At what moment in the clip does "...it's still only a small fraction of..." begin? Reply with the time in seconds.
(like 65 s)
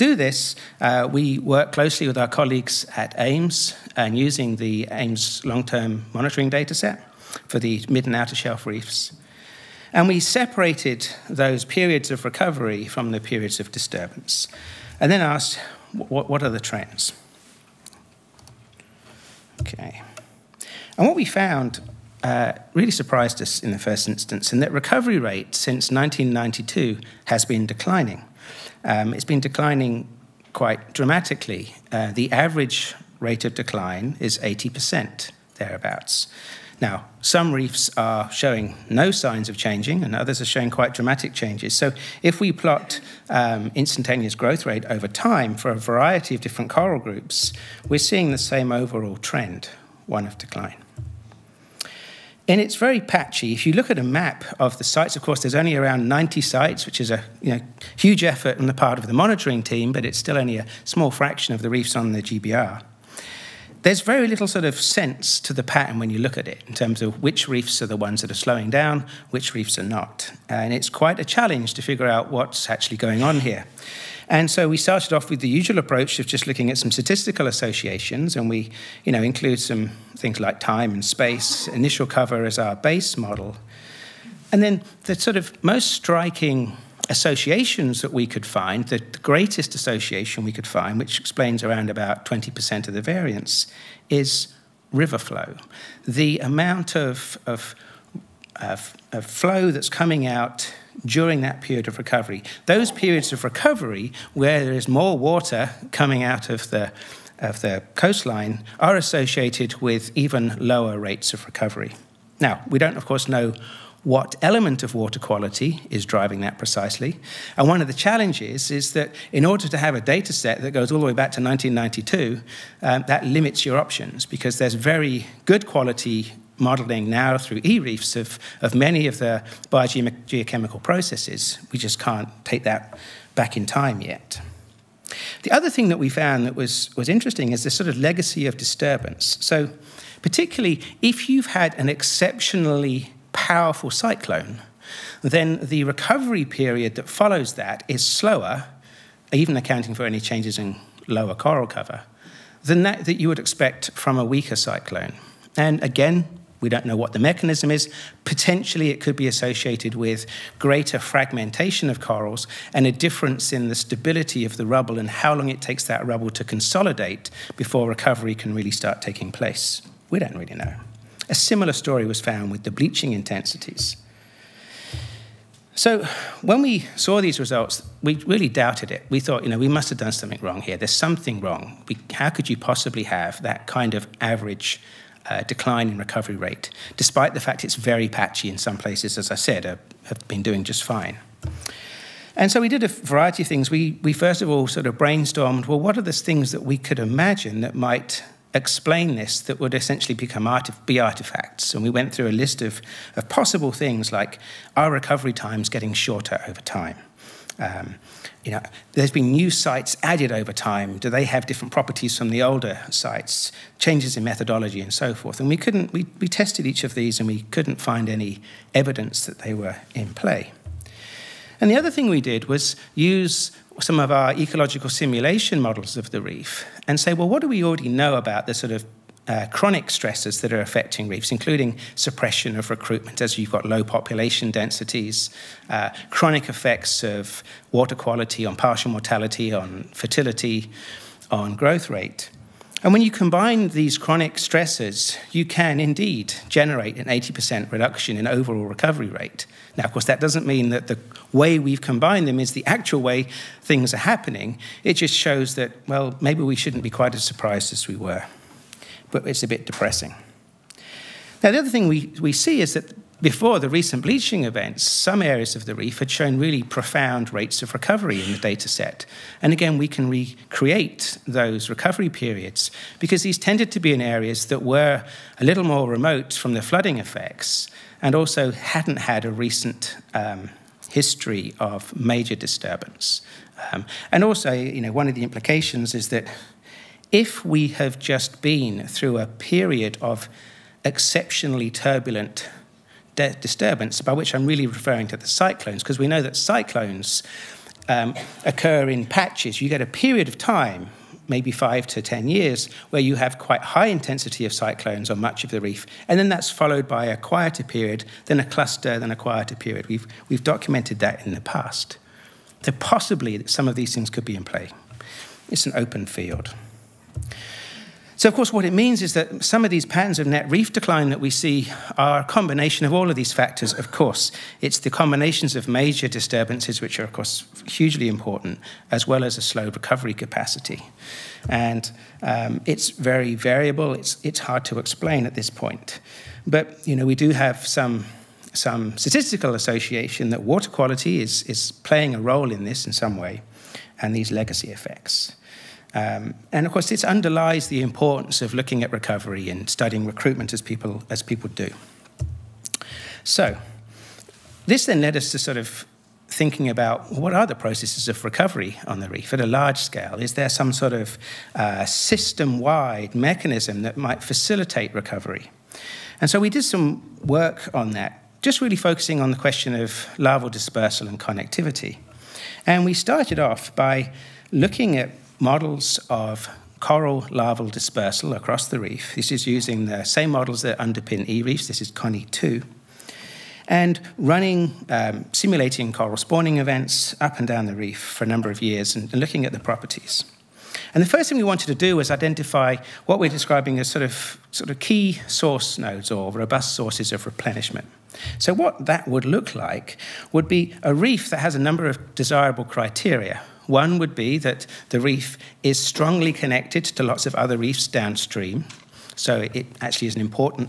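60 s.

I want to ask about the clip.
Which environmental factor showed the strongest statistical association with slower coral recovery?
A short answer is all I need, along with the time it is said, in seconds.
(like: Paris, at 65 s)
River flow, at 94 s.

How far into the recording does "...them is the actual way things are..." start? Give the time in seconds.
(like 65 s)
252 s.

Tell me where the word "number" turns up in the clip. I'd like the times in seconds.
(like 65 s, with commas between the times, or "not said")
388 s, 401 s.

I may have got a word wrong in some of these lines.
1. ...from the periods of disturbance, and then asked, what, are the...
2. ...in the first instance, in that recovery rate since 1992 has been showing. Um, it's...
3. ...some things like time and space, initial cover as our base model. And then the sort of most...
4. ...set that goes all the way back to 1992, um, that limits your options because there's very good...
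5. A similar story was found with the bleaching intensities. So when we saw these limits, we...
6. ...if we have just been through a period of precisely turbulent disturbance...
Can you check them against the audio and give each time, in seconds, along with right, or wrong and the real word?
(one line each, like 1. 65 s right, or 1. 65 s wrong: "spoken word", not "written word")
1. 12 s right
2. 23 s wrong: "declining", not "showing"
3. 79 s right
4. 120 s right
5. 171 s wrong: "results", not "limits"
6. 287 s wrong: "exceptionally", not "precisely".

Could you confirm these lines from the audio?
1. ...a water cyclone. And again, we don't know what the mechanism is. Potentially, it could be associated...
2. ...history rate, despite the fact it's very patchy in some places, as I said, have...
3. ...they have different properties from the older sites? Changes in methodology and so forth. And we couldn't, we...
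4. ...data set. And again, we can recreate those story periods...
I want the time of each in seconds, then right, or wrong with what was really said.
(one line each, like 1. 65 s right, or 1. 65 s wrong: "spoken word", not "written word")
1. 154 s wrong: "weaker", not "water"
2. 185 s wrong: "recovery", not "history"
3. 211 s right
4. 268 s wrong: "recovery", not "story".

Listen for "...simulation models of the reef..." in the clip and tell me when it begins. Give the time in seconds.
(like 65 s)
224 s.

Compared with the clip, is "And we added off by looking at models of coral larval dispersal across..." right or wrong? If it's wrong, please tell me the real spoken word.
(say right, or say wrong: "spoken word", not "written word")
wrong: "started", not "added".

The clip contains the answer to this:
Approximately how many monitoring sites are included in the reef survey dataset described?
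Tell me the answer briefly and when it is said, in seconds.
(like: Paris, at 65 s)
90, at 56 s.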